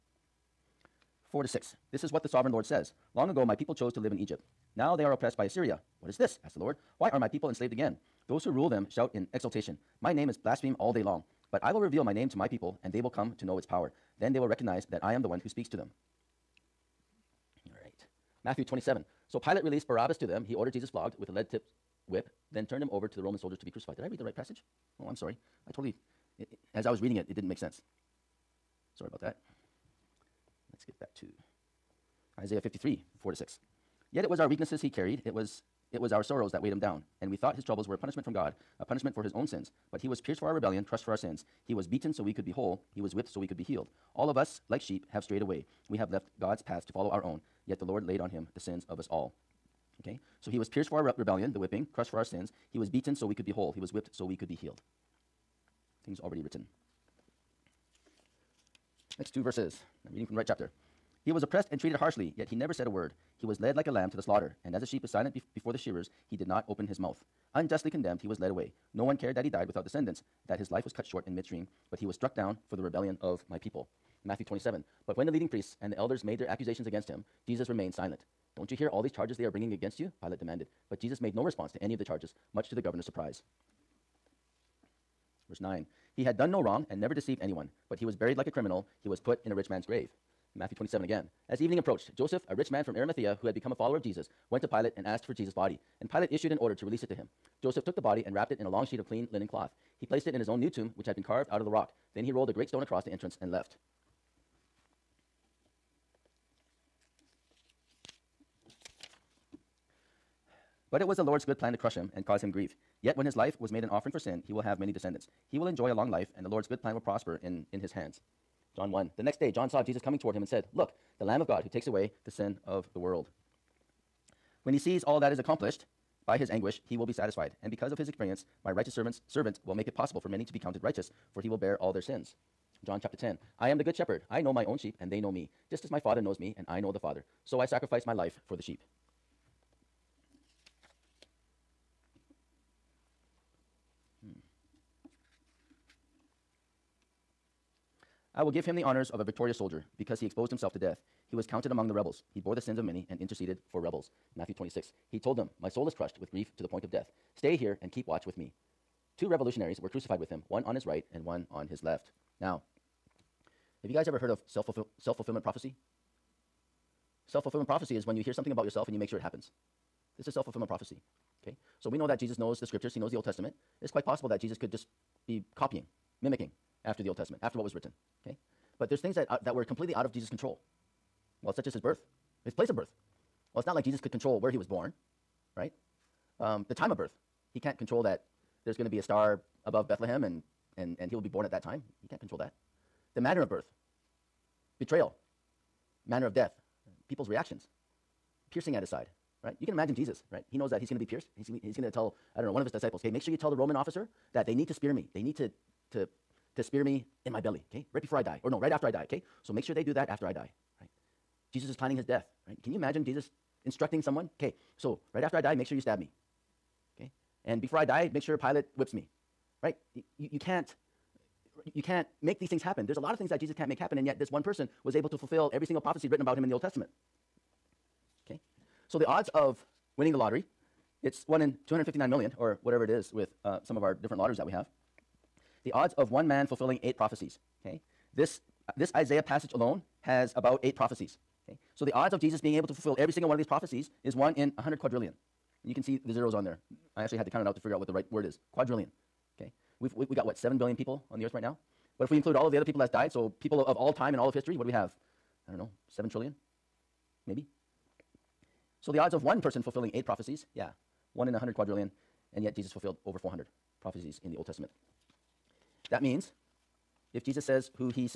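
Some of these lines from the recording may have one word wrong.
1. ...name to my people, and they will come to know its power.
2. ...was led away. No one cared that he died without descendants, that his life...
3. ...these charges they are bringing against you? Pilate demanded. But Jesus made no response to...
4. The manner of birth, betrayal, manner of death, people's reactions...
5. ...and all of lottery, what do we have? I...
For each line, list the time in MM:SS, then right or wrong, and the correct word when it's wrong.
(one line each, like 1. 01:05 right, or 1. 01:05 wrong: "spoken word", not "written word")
1. 00:12 right
2. 01:08 right
3. 01:19 right
4. 03:13 right
5. 04:14 wrong: "history", not "lottery".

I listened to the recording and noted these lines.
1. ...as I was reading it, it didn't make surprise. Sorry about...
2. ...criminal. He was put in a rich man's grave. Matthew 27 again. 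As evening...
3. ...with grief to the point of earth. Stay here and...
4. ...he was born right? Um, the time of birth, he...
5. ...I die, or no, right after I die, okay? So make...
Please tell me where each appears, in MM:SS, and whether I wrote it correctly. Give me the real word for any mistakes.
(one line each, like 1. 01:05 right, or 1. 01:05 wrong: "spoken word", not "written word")
1. 00:26 wrong: "sense", not "surprise"
2. 01:28 right
3. 02:36 wrong: "death", not "earth"
4. 03:04 right
5. 03:28 right.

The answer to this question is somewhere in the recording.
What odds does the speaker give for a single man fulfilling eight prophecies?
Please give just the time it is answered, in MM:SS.
04:04.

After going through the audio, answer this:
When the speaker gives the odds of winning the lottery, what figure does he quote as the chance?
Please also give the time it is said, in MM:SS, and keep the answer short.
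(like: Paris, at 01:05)
1 in 259 million, at 03:51.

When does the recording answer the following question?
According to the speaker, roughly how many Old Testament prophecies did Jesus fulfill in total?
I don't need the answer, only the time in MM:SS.
04:23.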